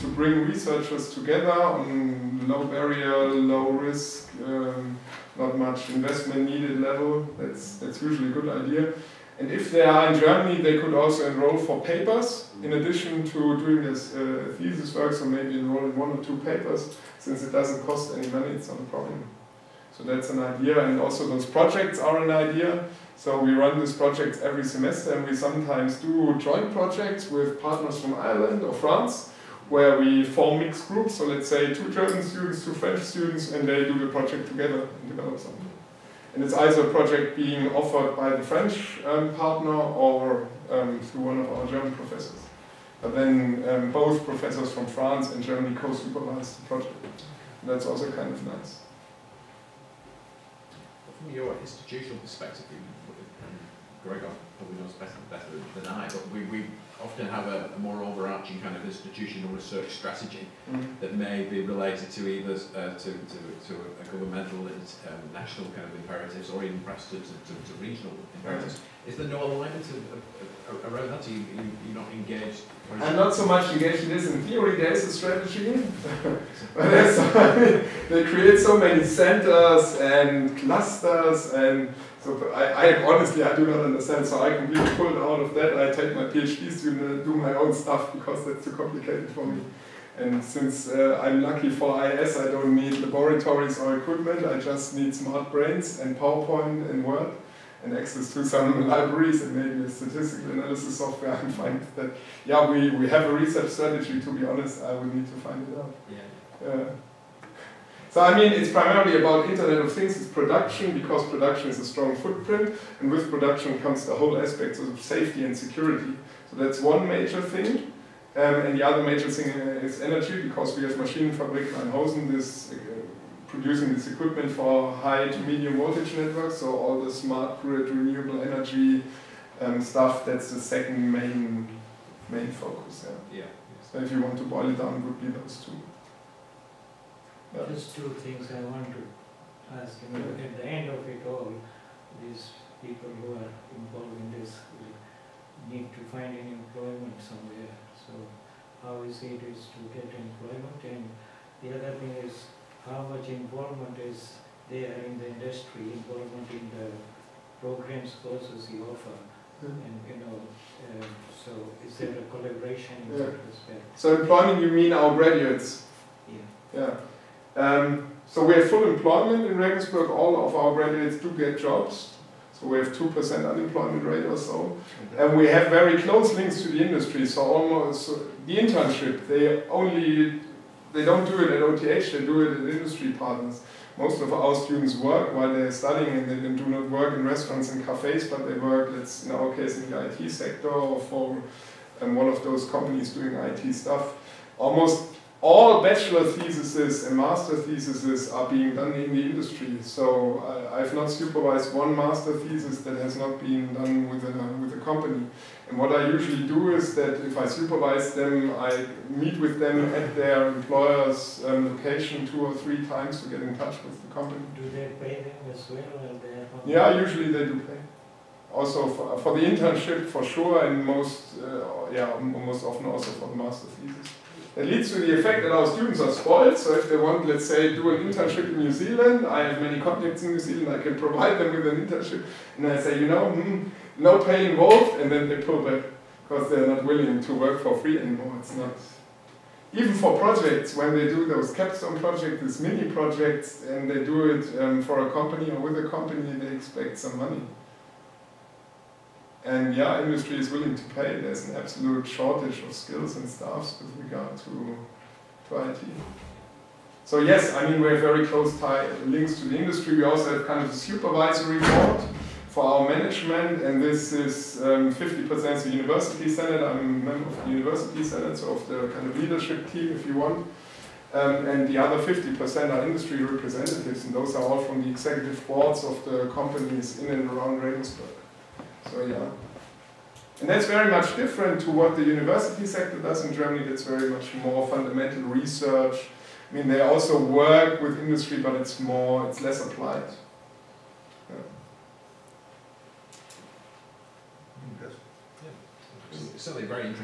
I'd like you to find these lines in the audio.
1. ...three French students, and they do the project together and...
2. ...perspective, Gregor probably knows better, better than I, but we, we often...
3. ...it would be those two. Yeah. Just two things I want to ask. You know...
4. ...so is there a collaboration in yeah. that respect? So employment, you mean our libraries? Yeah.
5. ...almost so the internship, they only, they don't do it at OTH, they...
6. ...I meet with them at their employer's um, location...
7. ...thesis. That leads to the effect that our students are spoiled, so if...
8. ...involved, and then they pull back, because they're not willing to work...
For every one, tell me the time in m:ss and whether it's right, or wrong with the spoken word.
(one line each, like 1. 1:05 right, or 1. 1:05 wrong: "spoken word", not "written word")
1. 0:32 wrong: "two", not "three"
2. 0:52 right
3. 2:14 right
4. 2:41 wrong: "graduates", not "libraries"
5. 2:57 right
6. 3:28 right
7. 3:43 right
8. 3:54 right.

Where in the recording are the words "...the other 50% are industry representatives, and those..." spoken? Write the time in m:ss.
4:31.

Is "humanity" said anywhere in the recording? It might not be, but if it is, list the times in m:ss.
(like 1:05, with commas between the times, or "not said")
not said.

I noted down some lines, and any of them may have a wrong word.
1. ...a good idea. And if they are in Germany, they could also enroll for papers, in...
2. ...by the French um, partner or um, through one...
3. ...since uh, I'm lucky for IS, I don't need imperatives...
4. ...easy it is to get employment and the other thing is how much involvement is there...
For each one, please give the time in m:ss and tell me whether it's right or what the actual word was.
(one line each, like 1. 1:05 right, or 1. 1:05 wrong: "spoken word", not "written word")
1. 0:08 right
2. 0:38 right
3. 1:30 wrong: "laboratories", not "imperatives"
4. 2:29 right.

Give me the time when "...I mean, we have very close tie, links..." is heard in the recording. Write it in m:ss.
4:17.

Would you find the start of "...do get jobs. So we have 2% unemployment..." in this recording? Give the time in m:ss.
2:51.